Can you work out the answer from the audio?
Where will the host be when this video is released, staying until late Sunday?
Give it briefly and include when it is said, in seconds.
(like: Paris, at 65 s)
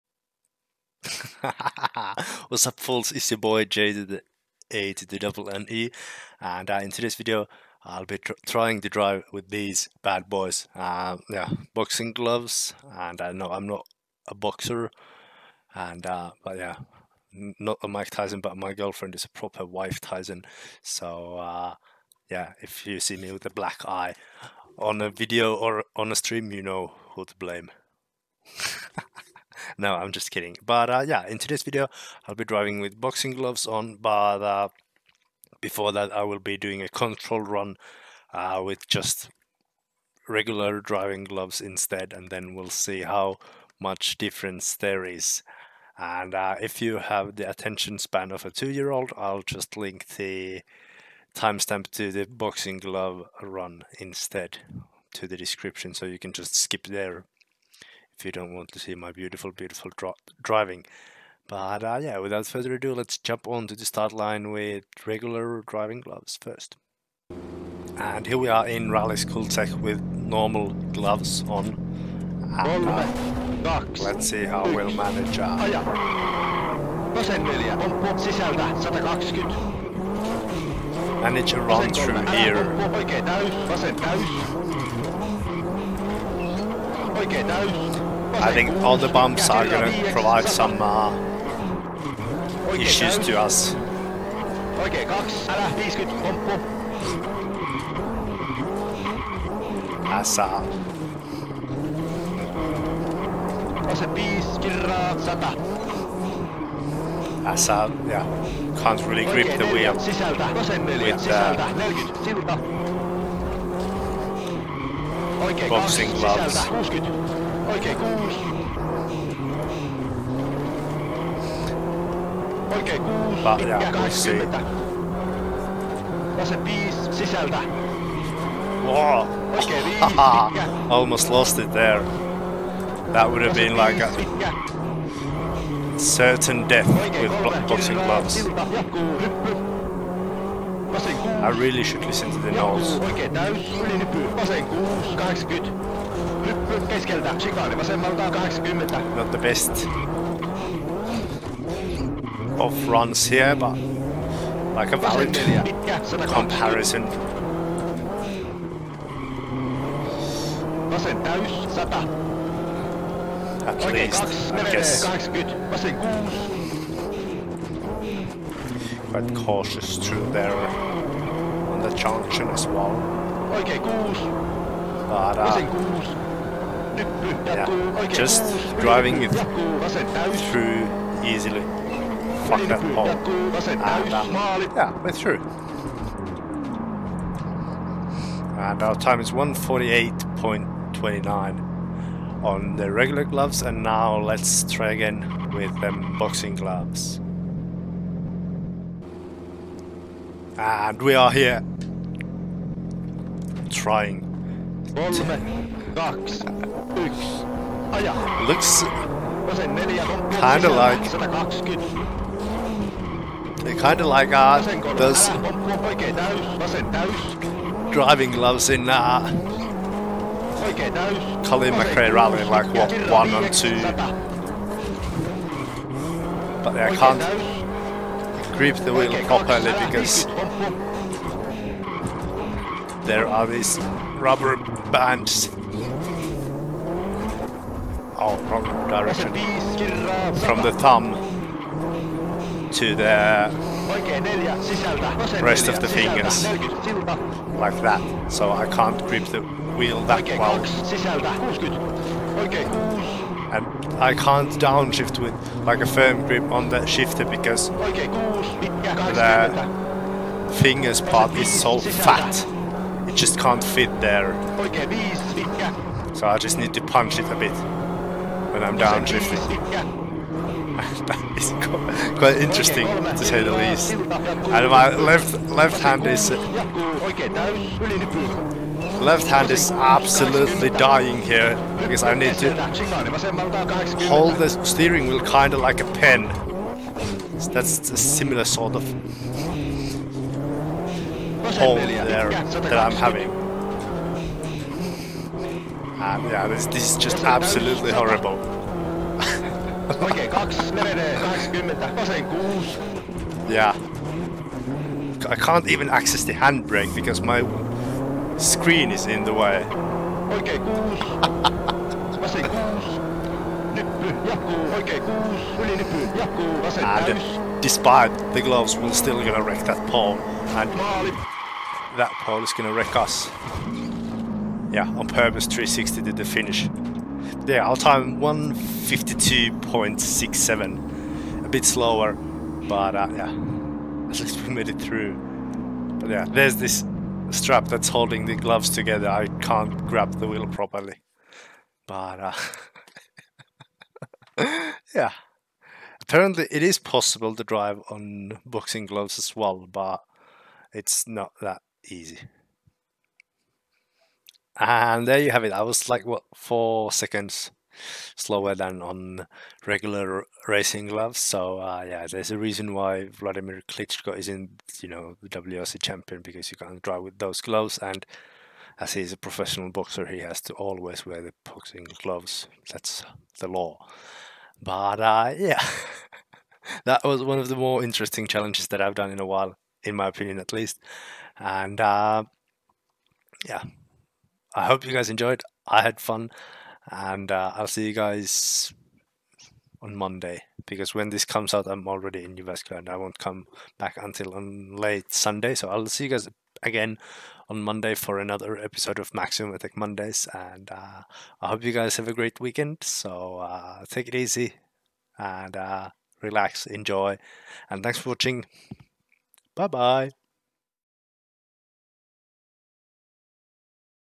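Jyväskylä, at 392 s.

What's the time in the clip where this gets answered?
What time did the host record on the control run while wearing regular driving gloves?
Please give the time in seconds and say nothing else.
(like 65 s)
189 s.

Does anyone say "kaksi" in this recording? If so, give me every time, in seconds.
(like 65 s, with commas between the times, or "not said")
95 s, 164 s.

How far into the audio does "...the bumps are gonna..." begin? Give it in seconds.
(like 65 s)
88 s.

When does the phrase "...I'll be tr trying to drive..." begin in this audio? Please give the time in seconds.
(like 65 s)
7 s.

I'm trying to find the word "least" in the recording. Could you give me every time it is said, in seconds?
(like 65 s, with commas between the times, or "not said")
163 s, 273 s, 334 s, 380 s.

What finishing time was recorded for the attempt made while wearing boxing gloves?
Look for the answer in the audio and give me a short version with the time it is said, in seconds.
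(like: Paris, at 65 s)
152.67, at 328 s.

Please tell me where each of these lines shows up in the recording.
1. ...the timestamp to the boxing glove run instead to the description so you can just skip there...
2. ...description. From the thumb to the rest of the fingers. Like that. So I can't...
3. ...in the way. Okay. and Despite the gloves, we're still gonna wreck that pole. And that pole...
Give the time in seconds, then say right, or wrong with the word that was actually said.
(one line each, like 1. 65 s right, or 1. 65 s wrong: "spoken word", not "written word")
1. 50 s right
2. 238 s wrong: "direction", not "description"
3. 309 s right.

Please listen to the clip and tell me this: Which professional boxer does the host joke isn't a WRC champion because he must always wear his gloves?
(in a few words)
Vladimir Klitschko.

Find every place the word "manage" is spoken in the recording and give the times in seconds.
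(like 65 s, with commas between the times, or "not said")
74 s, 81 s.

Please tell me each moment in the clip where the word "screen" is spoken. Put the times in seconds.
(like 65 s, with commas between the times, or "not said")
308 s.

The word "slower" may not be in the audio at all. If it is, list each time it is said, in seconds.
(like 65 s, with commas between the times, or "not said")
331 s, 358 s.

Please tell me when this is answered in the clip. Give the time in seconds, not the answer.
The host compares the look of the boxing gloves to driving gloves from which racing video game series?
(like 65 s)
221 s.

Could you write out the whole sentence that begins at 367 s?
And as he's a professional boxer, he has to always wear the boxing gloves.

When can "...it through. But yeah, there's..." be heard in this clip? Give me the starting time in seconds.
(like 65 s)
334 s.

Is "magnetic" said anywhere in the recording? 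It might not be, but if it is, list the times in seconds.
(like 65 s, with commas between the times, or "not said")
not said.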